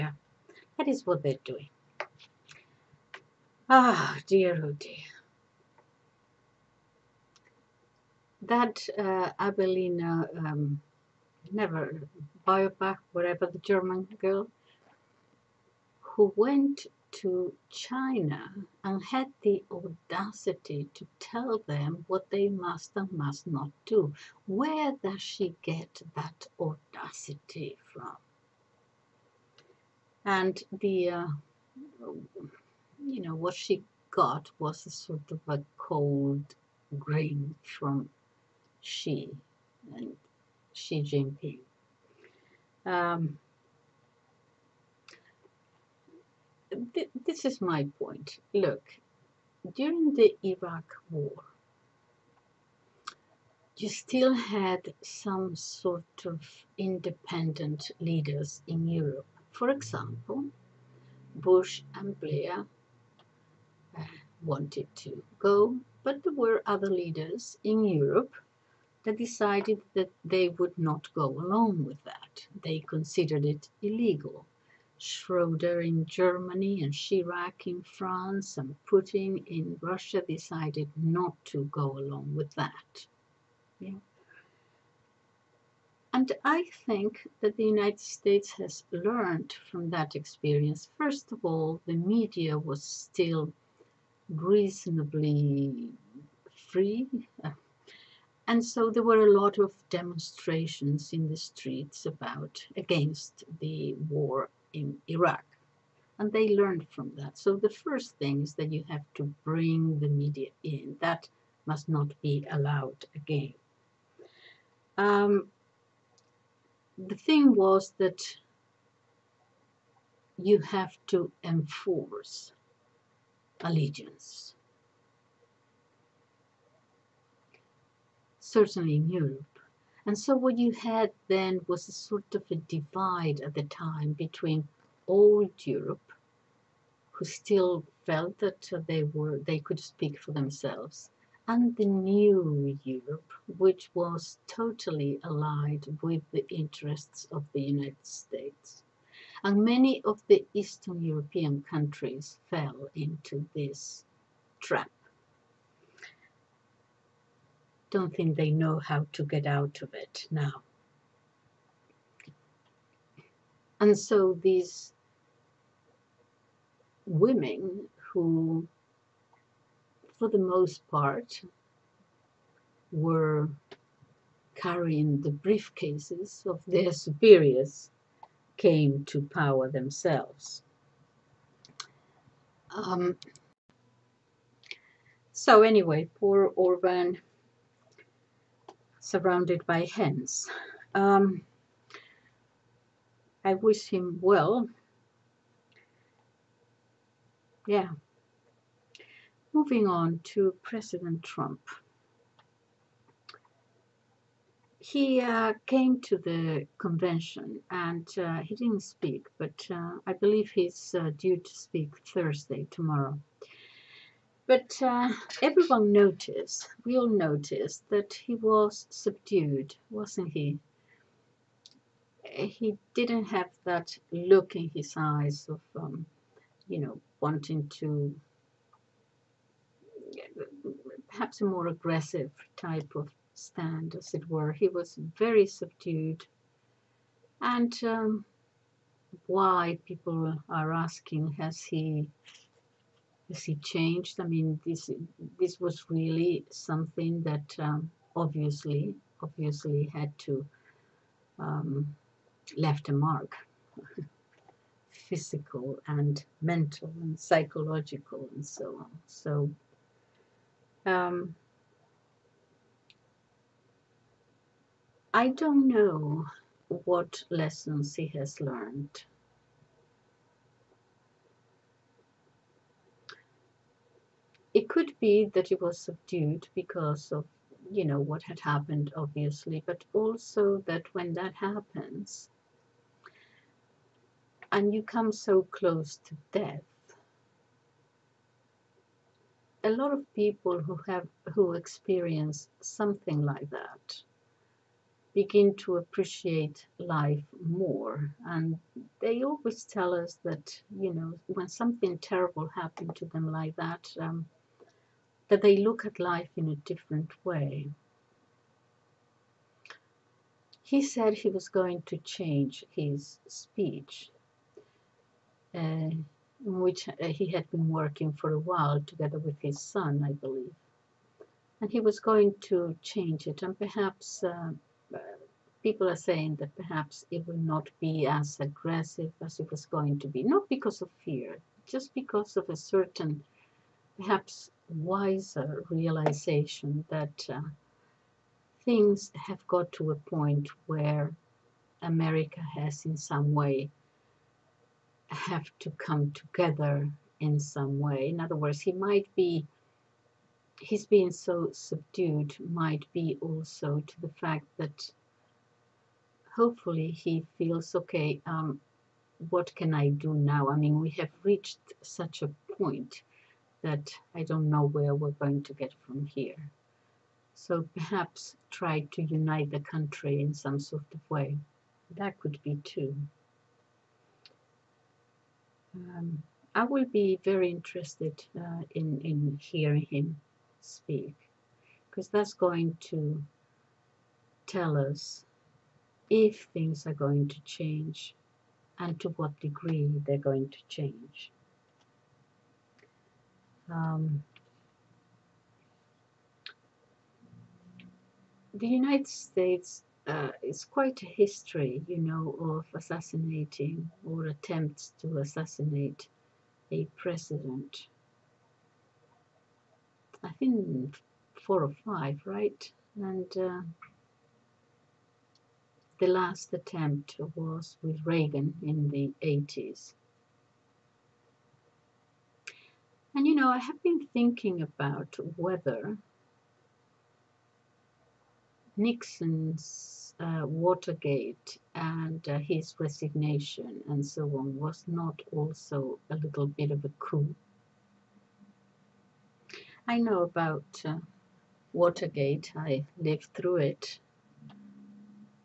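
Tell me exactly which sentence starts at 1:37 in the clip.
Uh, and so there were a lot of demonstrations in the streets about against the war in Iraq.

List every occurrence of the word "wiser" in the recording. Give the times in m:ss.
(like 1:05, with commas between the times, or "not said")
5:34.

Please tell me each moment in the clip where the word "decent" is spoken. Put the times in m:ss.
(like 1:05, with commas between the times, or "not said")
not said.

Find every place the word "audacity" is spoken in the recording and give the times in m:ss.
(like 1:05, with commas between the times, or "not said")
0:19, 0:26.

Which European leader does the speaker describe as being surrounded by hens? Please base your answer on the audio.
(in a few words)
Orban.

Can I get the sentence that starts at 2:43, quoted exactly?
And so these women who, for the most part, were carrying the briefcases of their superiors came to power themselves.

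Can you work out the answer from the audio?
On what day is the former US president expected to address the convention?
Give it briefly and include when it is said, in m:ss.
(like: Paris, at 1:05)
Thursday, at 3:32.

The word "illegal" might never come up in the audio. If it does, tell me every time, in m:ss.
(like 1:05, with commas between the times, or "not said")
1:13.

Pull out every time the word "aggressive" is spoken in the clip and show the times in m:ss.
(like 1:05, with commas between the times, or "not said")
3:51, 5:28.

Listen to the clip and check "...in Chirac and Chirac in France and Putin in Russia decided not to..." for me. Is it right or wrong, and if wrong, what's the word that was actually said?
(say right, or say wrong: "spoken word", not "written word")
wrong: "Germany", not "Chirac".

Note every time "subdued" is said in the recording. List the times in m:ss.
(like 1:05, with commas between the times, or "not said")
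3:38, 3:55, 4:35, 5:51.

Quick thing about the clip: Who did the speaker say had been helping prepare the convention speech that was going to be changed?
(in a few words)
his son.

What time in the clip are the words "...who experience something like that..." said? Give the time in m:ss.
4:51.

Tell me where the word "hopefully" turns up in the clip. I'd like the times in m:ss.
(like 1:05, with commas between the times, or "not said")
5:56.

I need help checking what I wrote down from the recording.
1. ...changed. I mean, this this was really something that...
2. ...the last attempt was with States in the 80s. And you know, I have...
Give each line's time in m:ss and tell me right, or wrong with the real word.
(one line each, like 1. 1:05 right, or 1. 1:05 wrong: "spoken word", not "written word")
1. 4:03 right
2. 6:55 wrong: "Reagan", not "States".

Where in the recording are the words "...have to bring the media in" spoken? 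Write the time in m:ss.
1:48.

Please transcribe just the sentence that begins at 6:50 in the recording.
I think four or five, right?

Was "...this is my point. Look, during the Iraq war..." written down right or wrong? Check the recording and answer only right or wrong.
right.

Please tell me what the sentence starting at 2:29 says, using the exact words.
And many of the Eastern European countries fell into this trap don't think they know how to get out of it now.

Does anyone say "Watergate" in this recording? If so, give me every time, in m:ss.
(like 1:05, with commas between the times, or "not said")
7:10, 7:21.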